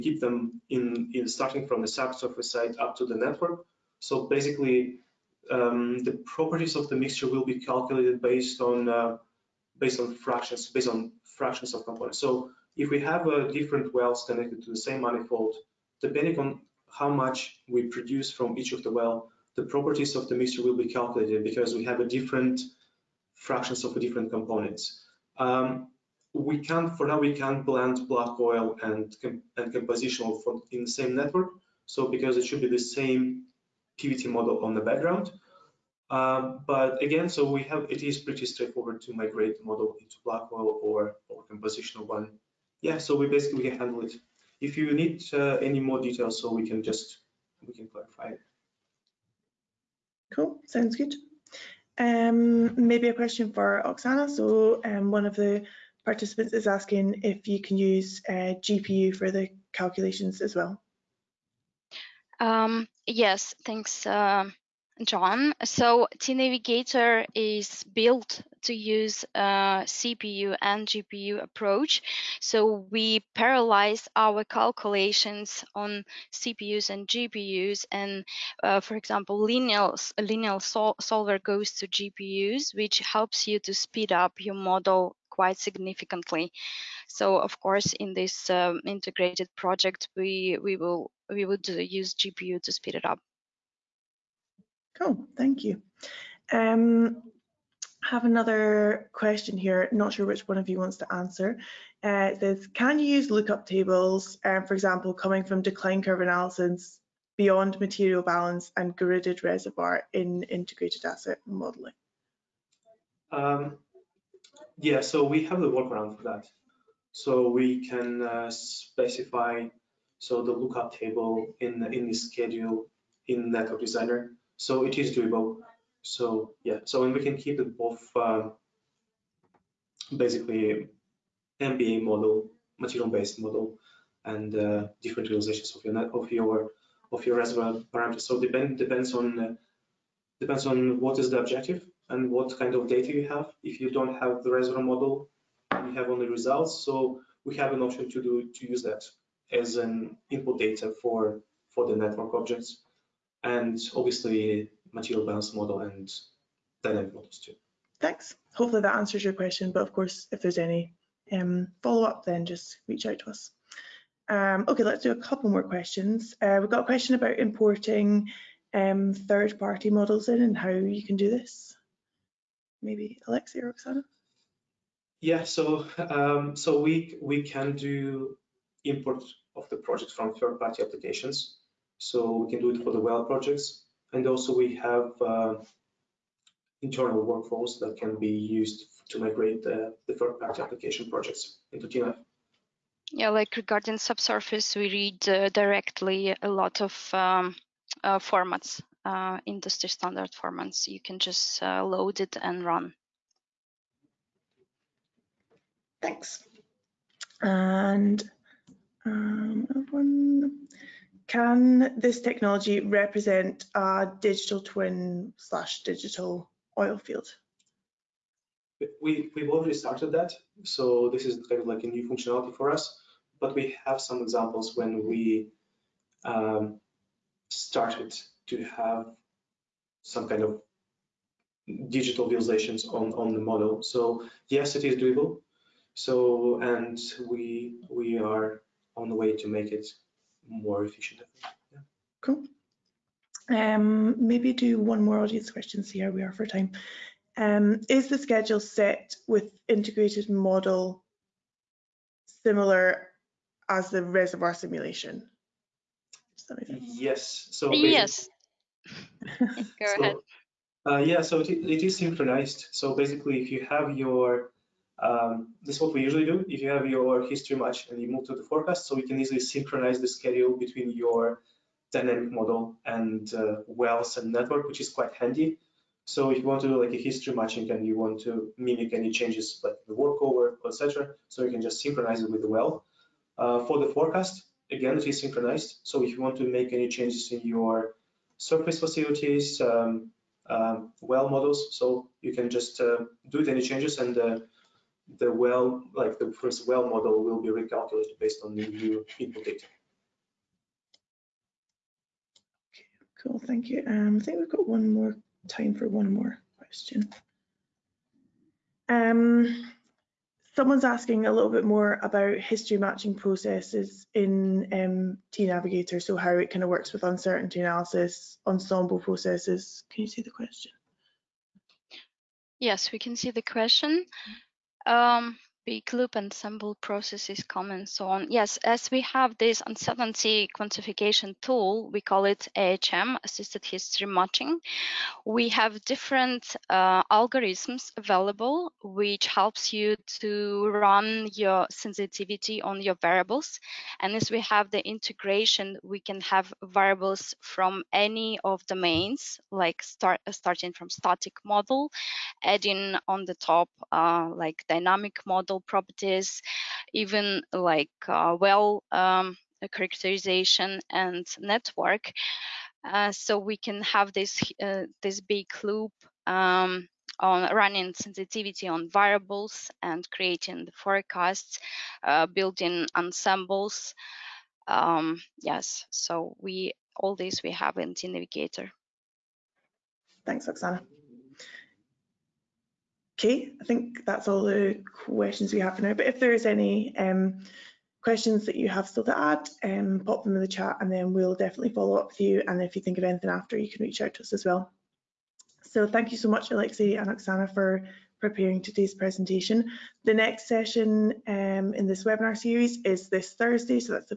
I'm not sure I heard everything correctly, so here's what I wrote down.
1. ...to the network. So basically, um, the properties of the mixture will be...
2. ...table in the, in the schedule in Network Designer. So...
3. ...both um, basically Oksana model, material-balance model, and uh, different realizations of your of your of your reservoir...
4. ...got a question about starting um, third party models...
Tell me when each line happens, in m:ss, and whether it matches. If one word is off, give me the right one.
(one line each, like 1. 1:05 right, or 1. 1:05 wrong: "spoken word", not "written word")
1. 0:02 right
2. 2:00 right
3. 2:07 wrong: "MBA", not "Oksana"
4. 2:46 wrong: "importing", not "starting".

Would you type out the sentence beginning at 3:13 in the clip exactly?
Yeah, like regarding subsurface, we read uh, directly a lot of um, uh, formats, uh, industry standard formats.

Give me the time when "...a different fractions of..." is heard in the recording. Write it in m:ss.
0:22.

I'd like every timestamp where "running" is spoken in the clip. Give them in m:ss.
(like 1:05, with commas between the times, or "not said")
6:07.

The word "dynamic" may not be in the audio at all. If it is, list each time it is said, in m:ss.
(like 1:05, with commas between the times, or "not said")
2:36, 4:31, 5:54.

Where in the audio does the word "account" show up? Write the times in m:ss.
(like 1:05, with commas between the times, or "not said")
not said.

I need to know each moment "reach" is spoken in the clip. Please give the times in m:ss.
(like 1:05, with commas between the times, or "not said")
2:42, 6:33.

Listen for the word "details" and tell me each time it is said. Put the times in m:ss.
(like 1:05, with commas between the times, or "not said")
0:46.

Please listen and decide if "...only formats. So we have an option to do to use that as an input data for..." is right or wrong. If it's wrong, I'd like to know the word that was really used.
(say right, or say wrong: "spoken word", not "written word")
wrong: "results", not "formats".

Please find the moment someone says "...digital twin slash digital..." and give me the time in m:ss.
3:34.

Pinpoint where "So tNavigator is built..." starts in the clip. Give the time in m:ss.
1:05.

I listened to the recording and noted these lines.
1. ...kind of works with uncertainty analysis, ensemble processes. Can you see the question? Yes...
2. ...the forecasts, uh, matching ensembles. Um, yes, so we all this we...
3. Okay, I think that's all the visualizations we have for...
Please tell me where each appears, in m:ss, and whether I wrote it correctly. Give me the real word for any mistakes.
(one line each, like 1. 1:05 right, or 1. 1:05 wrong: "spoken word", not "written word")
1. 5:16 right
2. 6:10 wrong: "building", not "matching"
3. 6:23 wrong: "questions", not "visualizations".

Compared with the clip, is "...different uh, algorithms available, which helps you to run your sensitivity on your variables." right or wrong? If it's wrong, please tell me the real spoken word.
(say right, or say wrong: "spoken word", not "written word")
right.